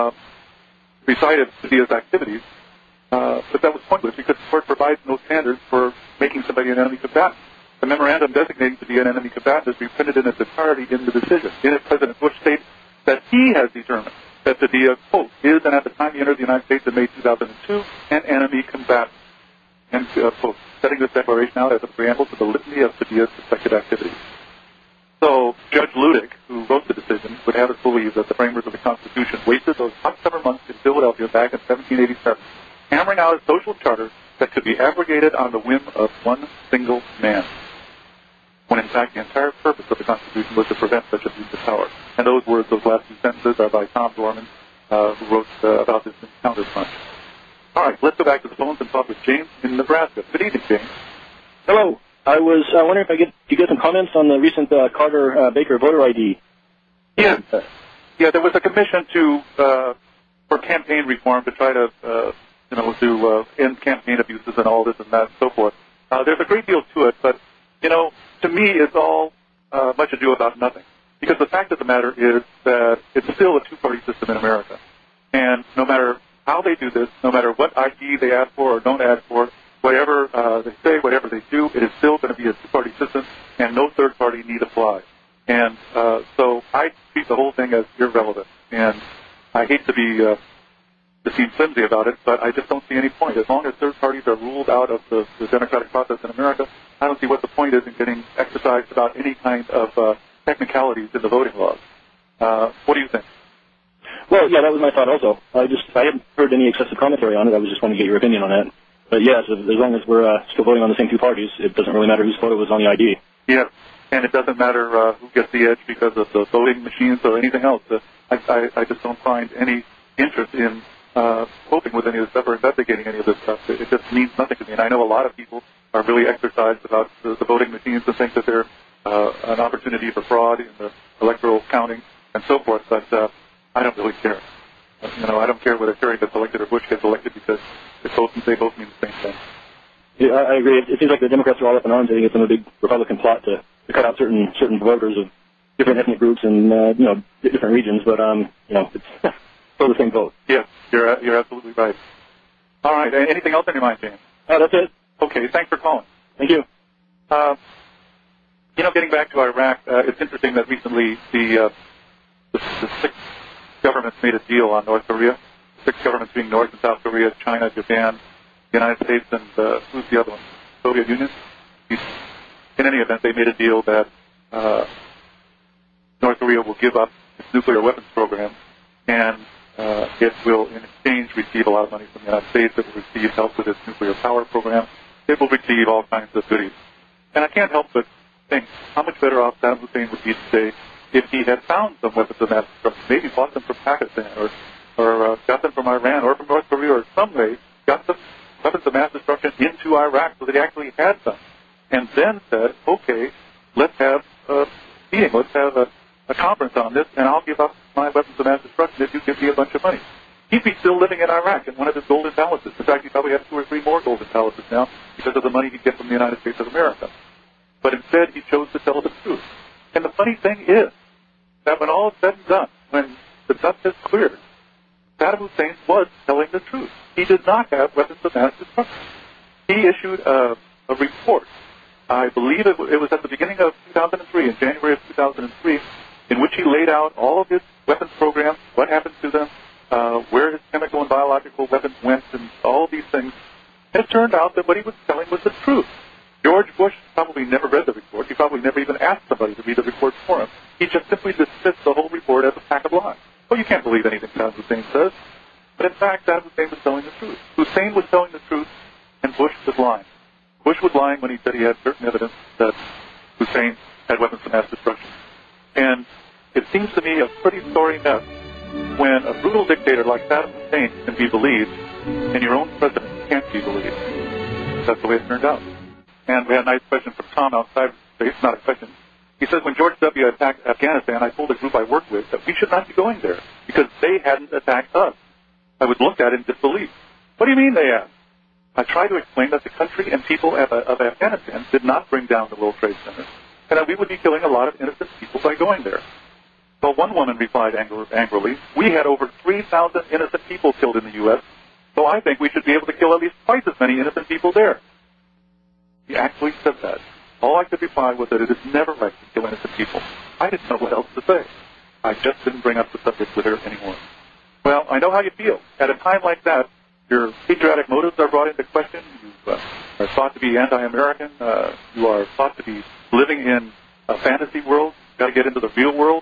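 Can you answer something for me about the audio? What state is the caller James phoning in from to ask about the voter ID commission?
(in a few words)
Nebraska.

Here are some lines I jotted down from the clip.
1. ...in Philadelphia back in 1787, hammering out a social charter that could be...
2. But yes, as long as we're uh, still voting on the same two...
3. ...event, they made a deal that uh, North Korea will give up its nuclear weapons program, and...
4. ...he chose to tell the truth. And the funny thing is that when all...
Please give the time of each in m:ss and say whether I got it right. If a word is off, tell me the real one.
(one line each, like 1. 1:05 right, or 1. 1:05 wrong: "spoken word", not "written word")
1. 0:30 right
2. 1:49 right
3. 2:52 right
4. 3:38 right.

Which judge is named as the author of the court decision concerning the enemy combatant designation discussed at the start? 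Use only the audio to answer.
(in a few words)
Judge Luttig.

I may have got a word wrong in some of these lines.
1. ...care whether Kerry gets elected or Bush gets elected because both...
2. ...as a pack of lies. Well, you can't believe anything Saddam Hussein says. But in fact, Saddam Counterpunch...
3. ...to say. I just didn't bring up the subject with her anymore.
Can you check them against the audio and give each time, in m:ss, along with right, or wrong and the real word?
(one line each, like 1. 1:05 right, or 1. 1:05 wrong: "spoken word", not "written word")
1. 2:15 right
2. 4:12 wrong: "Hussein", not "Counterpunch"
3. 5:11 right.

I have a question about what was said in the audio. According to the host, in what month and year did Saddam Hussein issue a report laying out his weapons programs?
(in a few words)
January 2003.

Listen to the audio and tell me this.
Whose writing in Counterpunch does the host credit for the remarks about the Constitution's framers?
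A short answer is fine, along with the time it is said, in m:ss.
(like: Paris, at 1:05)
Tom Dorman, at 0:43.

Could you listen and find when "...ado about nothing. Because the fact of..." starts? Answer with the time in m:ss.
1:10.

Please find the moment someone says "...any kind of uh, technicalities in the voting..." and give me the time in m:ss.
1:39.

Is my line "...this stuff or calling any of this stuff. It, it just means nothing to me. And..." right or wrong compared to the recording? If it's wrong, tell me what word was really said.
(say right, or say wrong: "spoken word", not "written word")
wrong: "investigating", not "calling".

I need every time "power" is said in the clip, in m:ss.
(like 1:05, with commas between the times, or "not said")
0:41, 3:04.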